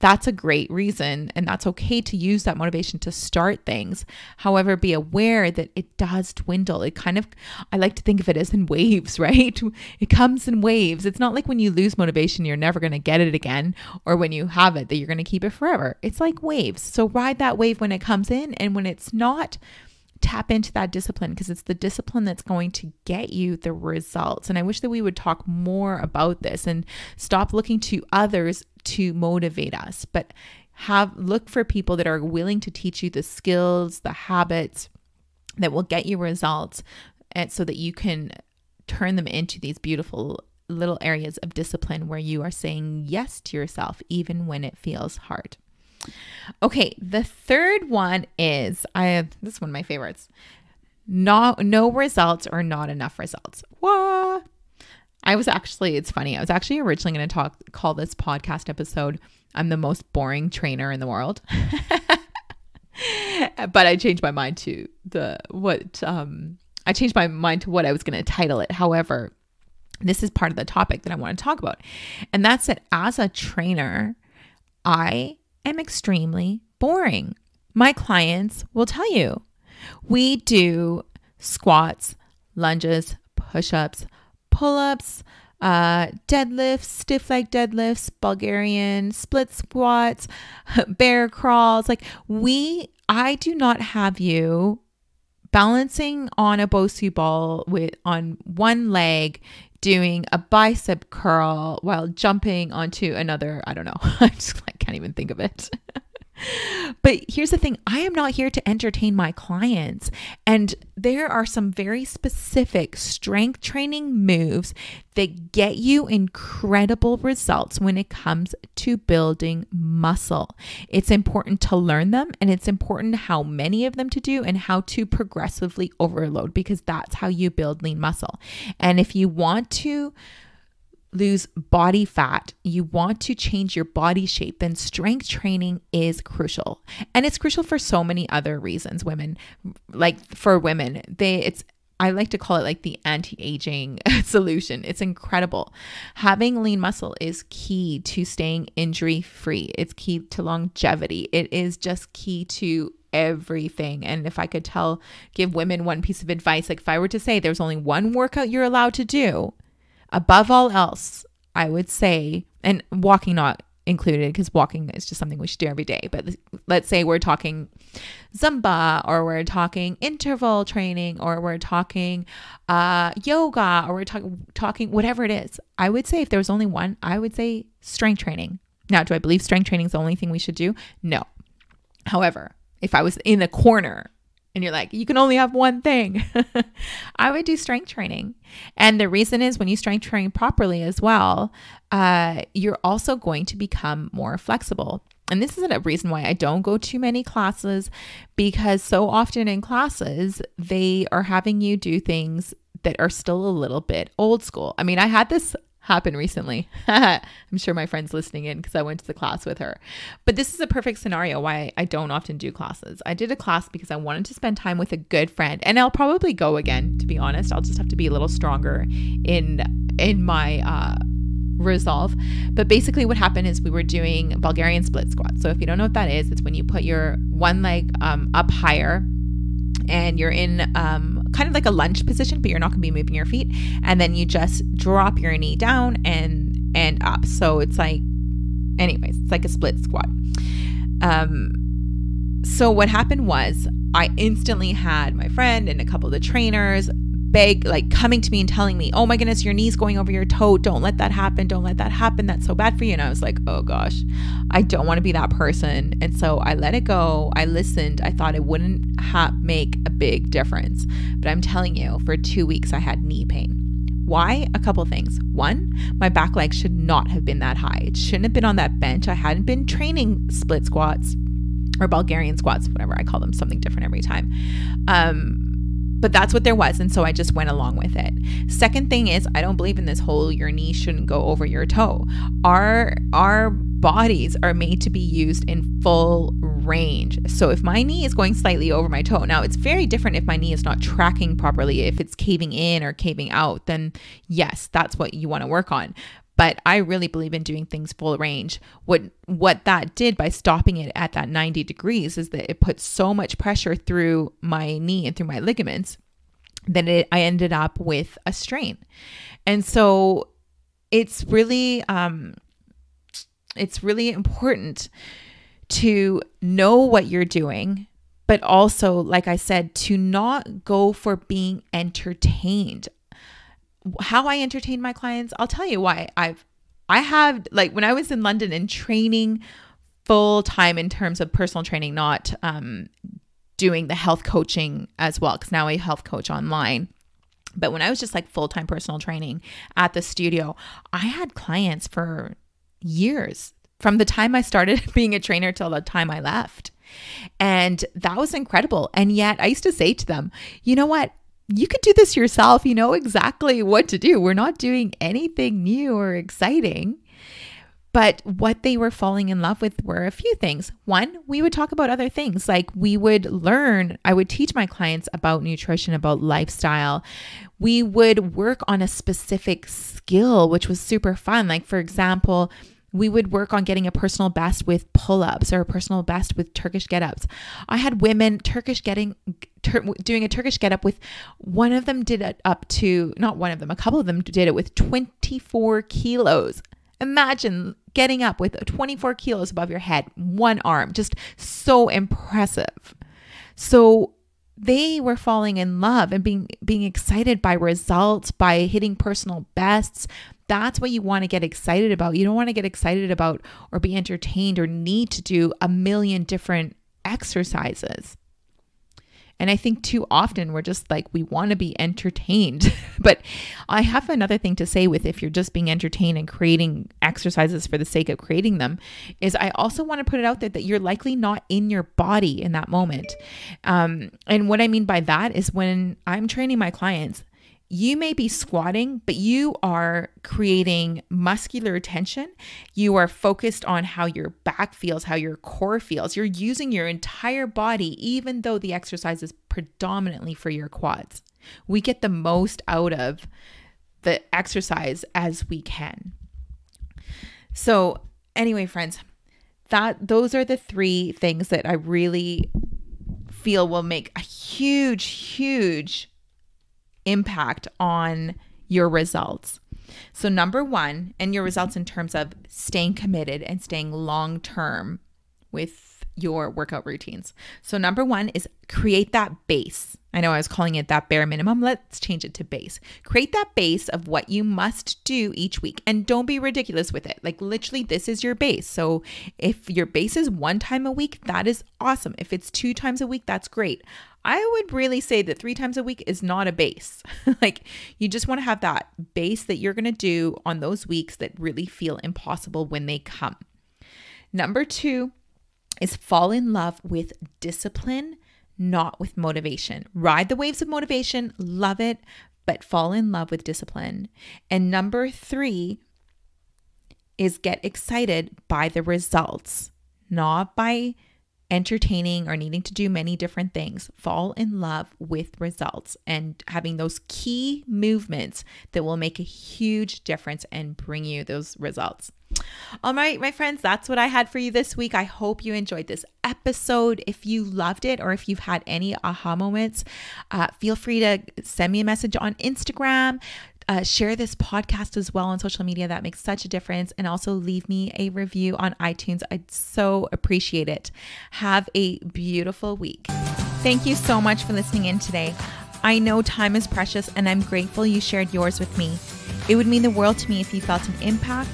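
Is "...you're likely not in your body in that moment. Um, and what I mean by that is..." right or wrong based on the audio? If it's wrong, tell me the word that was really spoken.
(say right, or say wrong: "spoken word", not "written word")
right.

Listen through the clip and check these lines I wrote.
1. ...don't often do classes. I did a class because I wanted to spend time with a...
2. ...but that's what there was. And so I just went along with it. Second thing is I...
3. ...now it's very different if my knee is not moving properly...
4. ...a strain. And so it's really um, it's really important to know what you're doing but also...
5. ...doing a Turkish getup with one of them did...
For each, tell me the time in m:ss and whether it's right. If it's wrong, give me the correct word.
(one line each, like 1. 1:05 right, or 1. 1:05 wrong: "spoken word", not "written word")
1. 3:31 right
2. 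4:35 right
3. 4:49 wrong: "tracking", not "moving"
4. 5:08 right
5. 6:20 right.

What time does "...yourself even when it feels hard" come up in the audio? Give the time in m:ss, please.
0:43.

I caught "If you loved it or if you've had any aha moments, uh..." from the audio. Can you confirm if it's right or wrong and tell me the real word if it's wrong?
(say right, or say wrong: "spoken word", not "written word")
right.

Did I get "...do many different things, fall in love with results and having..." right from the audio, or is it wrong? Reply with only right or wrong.
right.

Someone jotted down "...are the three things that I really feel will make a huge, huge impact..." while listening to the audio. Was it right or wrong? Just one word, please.
right.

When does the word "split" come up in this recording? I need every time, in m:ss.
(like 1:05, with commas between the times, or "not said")
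1:29, 3:44, 3:59, 4:30.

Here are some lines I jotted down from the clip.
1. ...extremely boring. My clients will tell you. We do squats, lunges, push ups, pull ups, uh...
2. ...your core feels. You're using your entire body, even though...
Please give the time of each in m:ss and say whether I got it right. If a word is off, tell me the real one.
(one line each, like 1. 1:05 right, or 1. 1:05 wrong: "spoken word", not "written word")
1. 1:15 right
2. 7:15 right.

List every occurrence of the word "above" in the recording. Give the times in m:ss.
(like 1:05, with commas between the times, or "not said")
2:40, 6:29.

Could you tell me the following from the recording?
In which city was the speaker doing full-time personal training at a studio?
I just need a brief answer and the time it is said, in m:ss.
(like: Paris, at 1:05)
London, at 5:28.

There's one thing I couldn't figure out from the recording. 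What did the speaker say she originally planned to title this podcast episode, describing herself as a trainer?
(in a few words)
The most boring trainer in the world.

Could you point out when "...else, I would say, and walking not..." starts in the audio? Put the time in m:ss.
2:40.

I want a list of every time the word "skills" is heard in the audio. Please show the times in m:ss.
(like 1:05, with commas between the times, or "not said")
0:33, 6:09.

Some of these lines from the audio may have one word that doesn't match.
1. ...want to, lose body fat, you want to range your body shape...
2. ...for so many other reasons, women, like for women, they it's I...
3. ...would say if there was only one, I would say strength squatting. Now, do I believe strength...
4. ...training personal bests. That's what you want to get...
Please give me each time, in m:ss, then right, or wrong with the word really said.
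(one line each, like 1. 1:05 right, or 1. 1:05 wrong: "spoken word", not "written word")
1. 2:09 wrong: "change", not "range"
2. 2:17 right
3. 2:55 wrong: "training", not "squatting"
4. 6:38 wrong: "hitting", not "training".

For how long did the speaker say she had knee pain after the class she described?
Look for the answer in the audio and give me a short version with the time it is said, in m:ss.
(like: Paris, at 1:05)
2 weeks, at 4:22.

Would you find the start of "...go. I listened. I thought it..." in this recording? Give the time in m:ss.
4:16.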